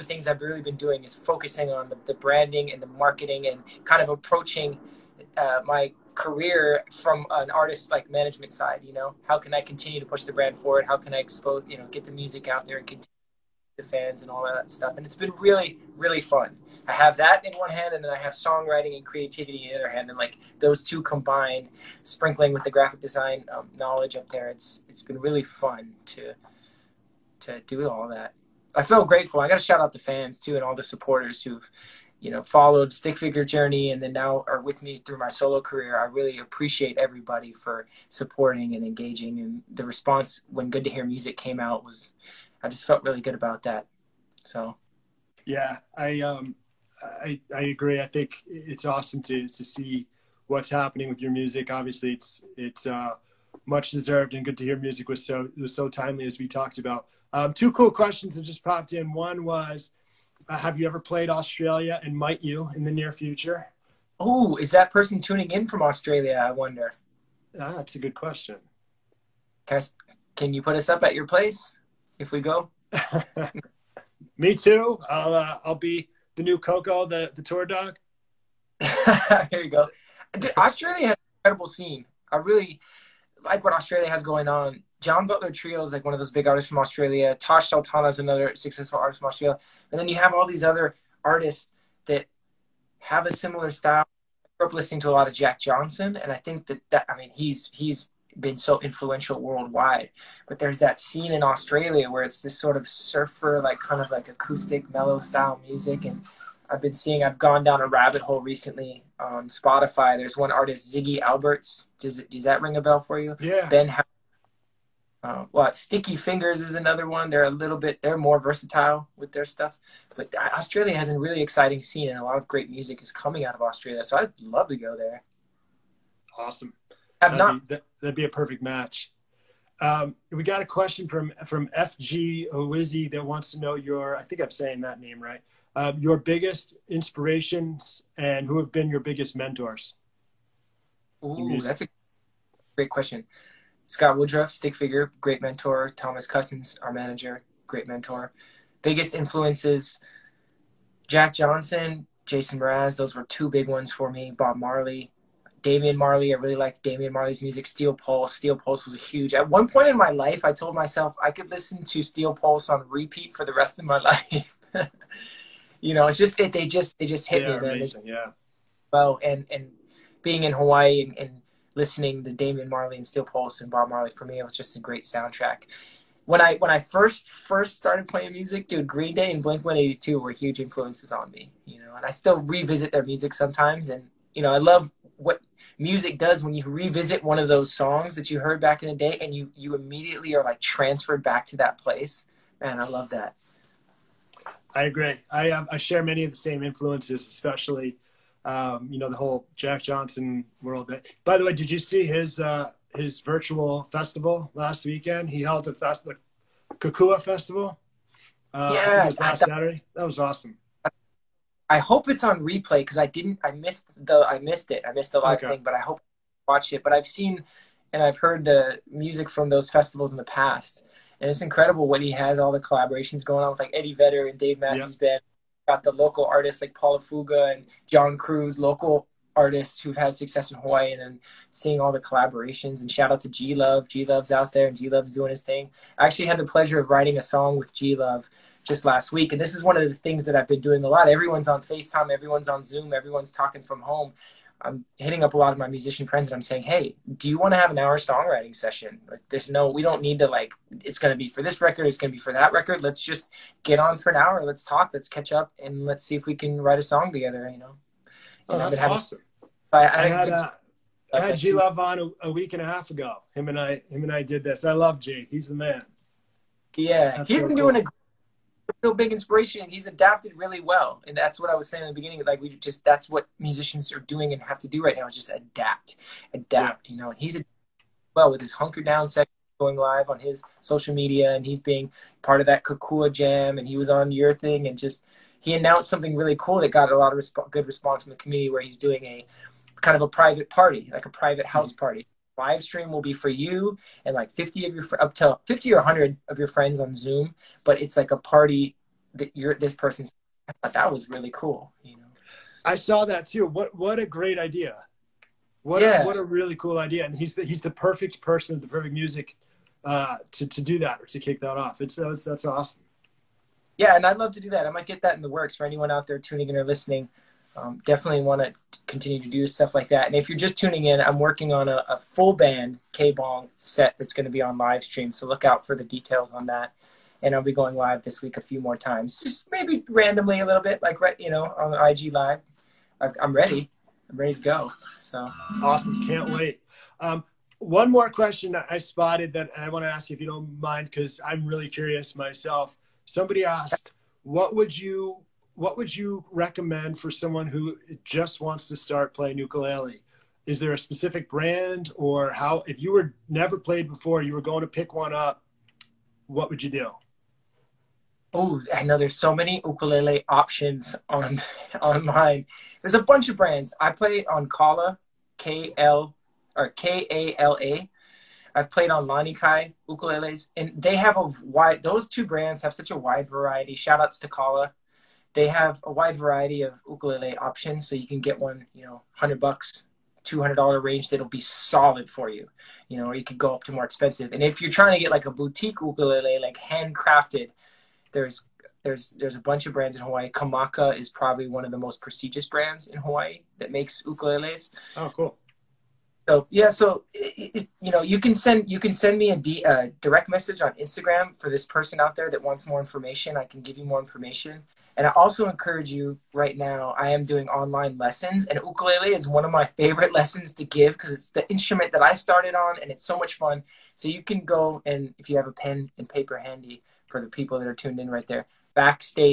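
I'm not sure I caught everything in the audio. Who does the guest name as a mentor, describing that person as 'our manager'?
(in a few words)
Thomas Cousins.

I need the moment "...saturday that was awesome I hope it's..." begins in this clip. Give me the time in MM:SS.
03:29.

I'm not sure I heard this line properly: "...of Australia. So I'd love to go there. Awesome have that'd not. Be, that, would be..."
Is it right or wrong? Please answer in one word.
right.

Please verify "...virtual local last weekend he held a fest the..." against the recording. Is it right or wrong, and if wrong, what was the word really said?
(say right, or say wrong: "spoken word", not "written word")
wrong: "festival", not "local".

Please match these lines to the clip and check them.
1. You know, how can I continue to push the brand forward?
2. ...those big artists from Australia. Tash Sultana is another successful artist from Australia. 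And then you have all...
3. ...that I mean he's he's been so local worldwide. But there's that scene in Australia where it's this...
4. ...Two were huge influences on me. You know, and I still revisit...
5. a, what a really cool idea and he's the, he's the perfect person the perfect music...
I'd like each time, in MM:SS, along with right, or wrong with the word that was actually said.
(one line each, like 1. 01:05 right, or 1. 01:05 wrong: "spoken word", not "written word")
1. 00:08 right
2. 01:26 right
3. 01:36 wrong: "influential", not "local"
4. 02:59 right
5. 05:06 right.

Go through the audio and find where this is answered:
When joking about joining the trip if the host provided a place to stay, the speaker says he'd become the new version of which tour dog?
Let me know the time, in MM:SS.
01:16.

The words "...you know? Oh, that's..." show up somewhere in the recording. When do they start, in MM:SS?
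04:17.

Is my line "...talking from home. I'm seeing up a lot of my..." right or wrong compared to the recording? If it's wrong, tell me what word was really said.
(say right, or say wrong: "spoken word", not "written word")
wrong: "hitting", not "seeing".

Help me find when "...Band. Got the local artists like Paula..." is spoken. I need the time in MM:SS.
03:44.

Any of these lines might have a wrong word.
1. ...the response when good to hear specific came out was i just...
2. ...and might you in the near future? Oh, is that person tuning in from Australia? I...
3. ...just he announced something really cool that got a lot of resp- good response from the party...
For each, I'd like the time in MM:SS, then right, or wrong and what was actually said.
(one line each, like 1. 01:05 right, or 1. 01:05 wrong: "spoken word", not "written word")
1. 00:39 wrong: "music", not "specific"
2. 01:02 right
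3. 04:44 wrong: "community", not "party".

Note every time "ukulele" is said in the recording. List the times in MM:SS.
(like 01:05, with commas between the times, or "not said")
05:49, 05:59, 06:09, 06:16, 06:25, 06:34, 06:48.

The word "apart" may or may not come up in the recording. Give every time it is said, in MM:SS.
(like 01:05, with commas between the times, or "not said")
not said.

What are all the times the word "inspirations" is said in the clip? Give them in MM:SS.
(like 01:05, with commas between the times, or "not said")
02:16, 04:29.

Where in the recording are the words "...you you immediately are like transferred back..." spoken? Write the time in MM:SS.
03:09.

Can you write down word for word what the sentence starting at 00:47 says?
I think it's awesome to, to see what's happening with your music.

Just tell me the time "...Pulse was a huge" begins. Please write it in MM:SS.
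02:38.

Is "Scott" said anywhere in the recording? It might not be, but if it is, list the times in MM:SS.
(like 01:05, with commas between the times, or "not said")
02:23.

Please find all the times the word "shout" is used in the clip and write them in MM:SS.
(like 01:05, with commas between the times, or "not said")
00:29, 03:52, 06:13.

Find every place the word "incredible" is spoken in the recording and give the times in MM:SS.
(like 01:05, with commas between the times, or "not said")
01:21, 03:41.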